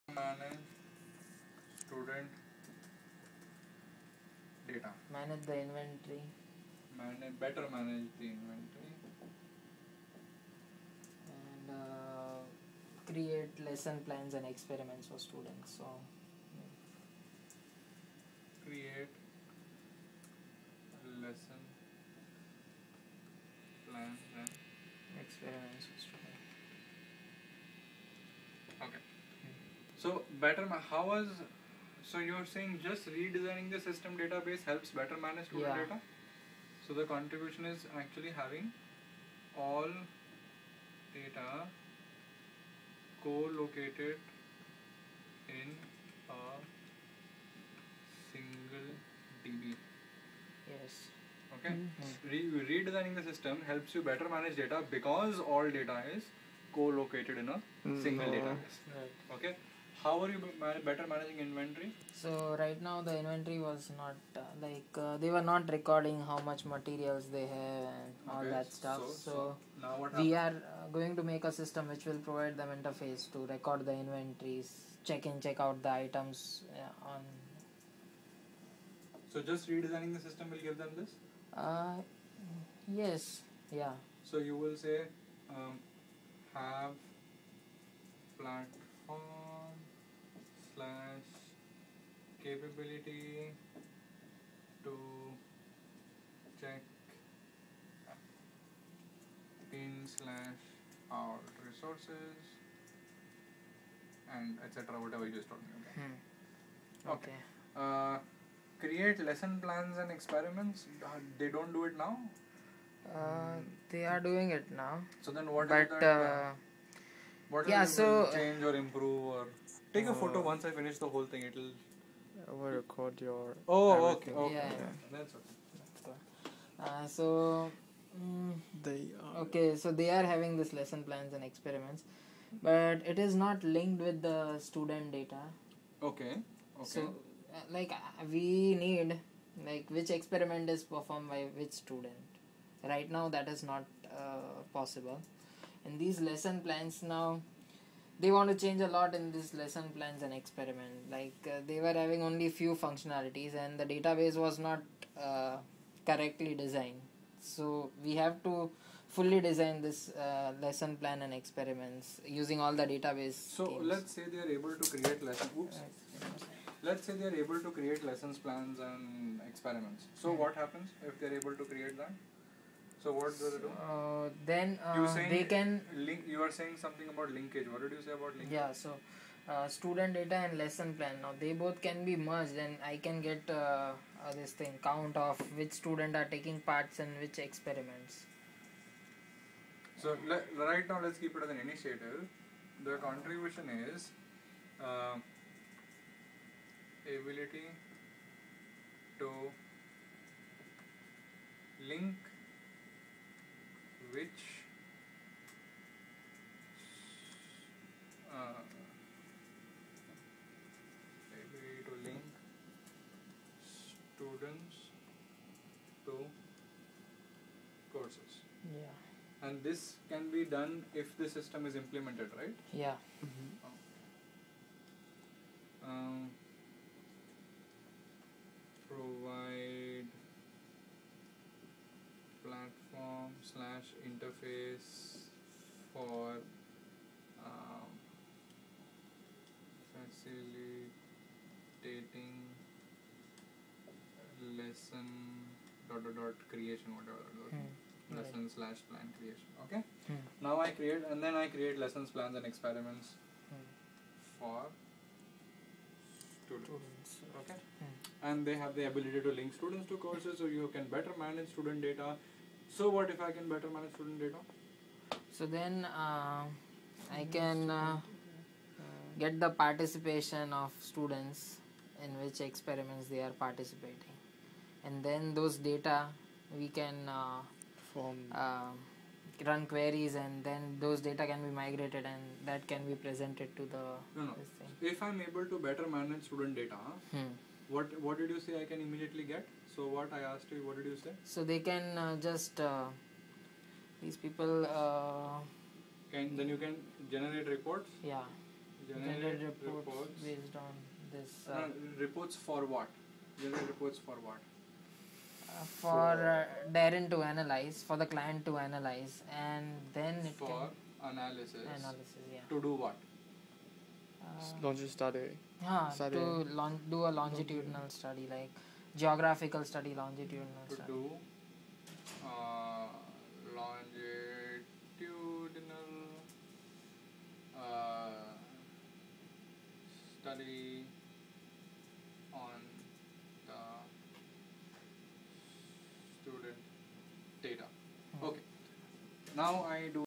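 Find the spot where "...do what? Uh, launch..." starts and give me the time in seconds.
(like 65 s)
312 s.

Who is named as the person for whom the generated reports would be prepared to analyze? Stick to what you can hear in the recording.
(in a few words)
Darren.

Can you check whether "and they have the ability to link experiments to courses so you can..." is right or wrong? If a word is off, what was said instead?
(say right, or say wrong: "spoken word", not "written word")
wrong: "students", not "experiments".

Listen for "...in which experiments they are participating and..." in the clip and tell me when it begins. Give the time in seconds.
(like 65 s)
272 s.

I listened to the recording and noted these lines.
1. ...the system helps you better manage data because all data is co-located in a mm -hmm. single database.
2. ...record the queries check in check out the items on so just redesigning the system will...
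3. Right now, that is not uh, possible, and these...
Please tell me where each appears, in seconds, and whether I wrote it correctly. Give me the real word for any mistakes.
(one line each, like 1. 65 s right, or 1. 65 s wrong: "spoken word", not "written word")
1. 53 s right
2. 73 s wrong: "inventories", not "queries"
3. 142 s right.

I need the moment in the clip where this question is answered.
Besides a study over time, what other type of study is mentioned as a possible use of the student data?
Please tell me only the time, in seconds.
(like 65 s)
318 s.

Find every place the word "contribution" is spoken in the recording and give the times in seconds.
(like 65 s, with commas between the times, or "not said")
37 s, 192 s.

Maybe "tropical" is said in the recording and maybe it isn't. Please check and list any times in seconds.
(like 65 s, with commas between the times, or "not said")
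not said.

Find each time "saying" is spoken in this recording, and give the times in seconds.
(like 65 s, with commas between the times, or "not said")
32 s, 176 s.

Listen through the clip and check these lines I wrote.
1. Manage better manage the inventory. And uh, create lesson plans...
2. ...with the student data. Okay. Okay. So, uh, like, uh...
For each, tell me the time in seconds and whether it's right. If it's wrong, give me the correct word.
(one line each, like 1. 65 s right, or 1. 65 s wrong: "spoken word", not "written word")
1. 6 s right
2. 134 s right.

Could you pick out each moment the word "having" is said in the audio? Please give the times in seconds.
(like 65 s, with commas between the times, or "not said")
38 s, 130 s, 151 s.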